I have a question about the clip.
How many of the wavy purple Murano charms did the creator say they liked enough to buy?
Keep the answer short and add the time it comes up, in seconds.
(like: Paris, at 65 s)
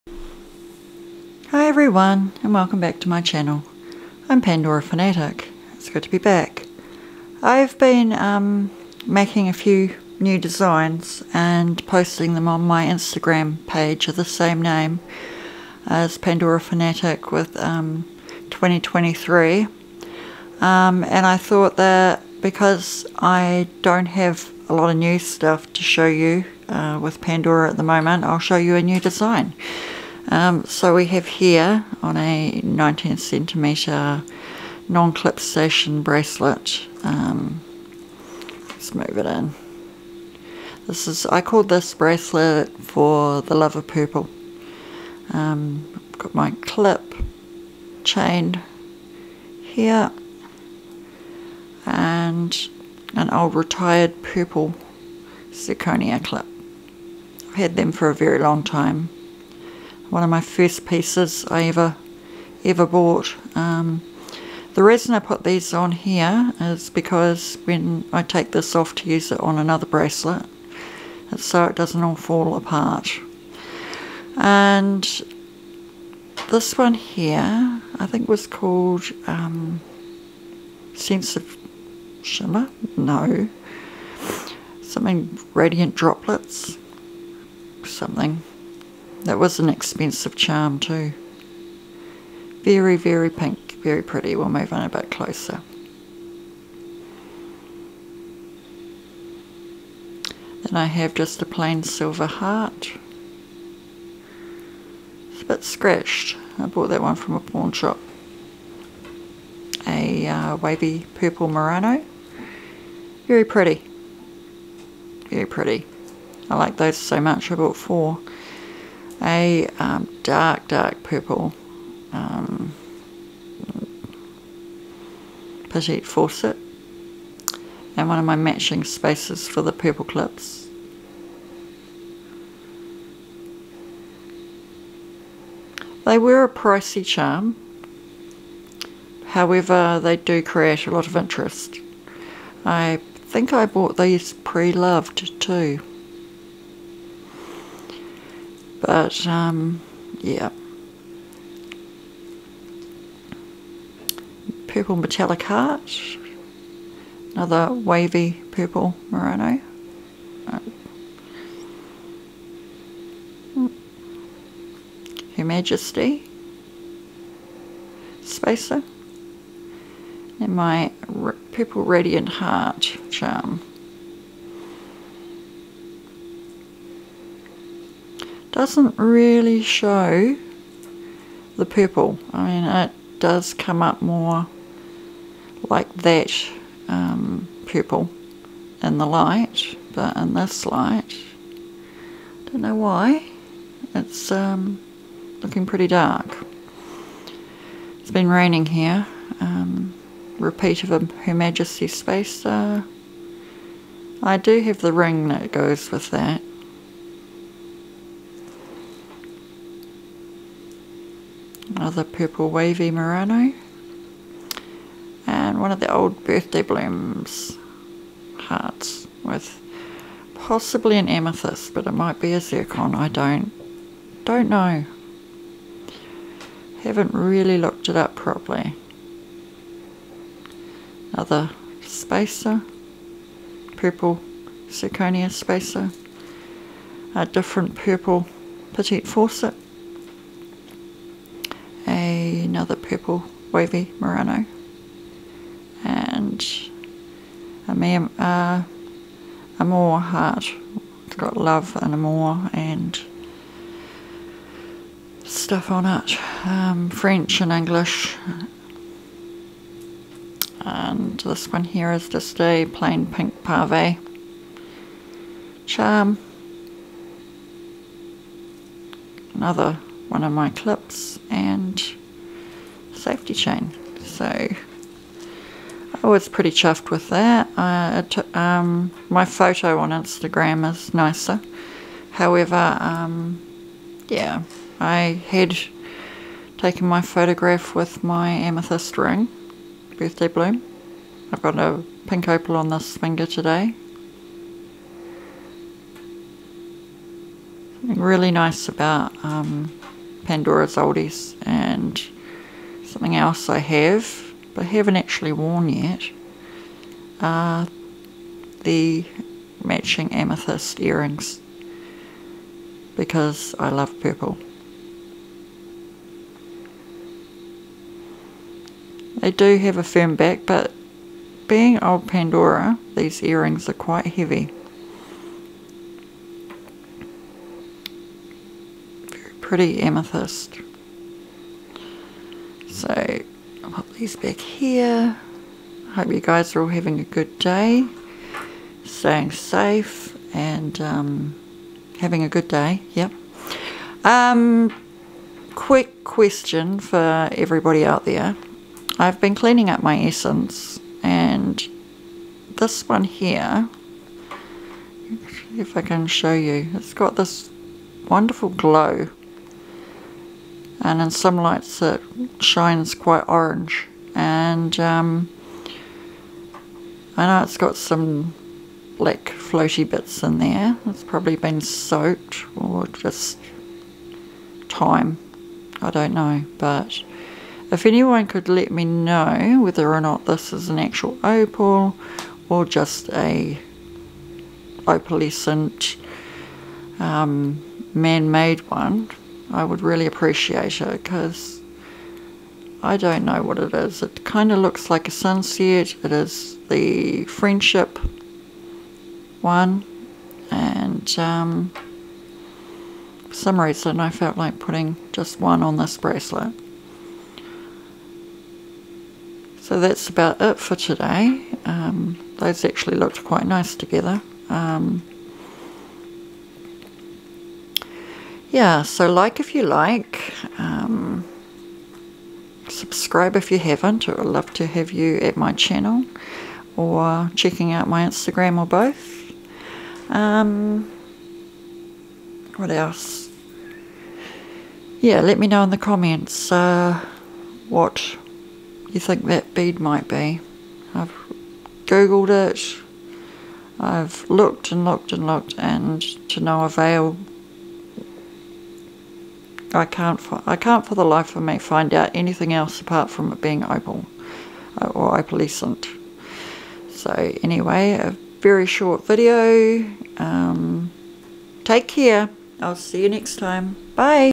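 4, at 117 s.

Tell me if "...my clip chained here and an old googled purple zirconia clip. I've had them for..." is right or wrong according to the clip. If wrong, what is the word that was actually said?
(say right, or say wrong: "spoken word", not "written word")
wrong: "retired", not "googled".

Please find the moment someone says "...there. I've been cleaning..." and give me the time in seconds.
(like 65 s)
348 s.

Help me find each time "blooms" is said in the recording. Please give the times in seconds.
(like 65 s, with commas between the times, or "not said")
216 s, 290 s.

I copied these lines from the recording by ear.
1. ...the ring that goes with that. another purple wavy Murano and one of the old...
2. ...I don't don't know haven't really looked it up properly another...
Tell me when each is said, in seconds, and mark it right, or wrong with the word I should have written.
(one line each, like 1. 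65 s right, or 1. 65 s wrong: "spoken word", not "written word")
1. 204 s right
2. 222 s right.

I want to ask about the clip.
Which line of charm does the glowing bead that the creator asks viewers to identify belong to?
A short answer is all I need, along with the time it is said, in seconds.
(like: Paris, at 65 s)
The friendship one, at 397 s.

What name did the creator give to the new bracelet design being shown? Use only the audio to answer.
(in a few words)
For the Love of Purple.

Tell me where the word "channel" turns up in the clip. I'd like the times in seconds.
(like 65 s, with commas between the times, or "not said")
3 s, 425 s.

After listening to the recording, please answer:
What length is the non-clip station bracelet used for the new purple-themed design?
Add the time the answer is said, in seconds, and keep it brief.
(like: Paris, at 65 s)
19 centimetres, at 32 s.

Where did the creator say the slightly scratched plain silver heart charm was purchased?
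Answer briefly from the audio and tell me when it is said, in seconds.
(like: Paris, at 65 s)
A pawn shop, at 107 s.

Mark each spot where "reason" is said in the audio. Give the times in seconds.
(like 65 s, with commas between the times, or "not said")
64 s, 403 s.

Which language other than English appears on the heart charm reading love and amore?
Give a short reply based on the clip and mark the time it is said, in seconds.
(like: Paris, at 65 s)
French, at 256 s.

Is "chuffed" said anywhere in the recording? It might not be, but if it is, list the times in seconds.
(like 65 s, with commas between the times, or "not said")
276 s.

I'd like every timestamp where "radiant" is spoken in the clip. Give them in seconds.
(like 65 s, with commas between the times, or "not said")
85 s, 171 s.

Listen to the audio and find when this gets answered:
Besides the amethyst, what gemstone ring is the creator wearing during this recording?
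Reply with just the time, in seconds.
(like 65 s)
292 s.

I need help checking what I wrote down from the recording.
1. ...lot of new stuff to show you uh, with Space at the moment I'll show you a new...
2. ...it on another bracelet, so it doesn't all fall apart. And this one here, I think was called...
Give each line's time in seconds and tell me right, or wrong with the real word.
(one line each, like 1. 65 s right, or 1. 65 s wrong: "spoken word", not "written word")
1. 24 s wrong: "Pandora", not "Space"
2. 69 s right.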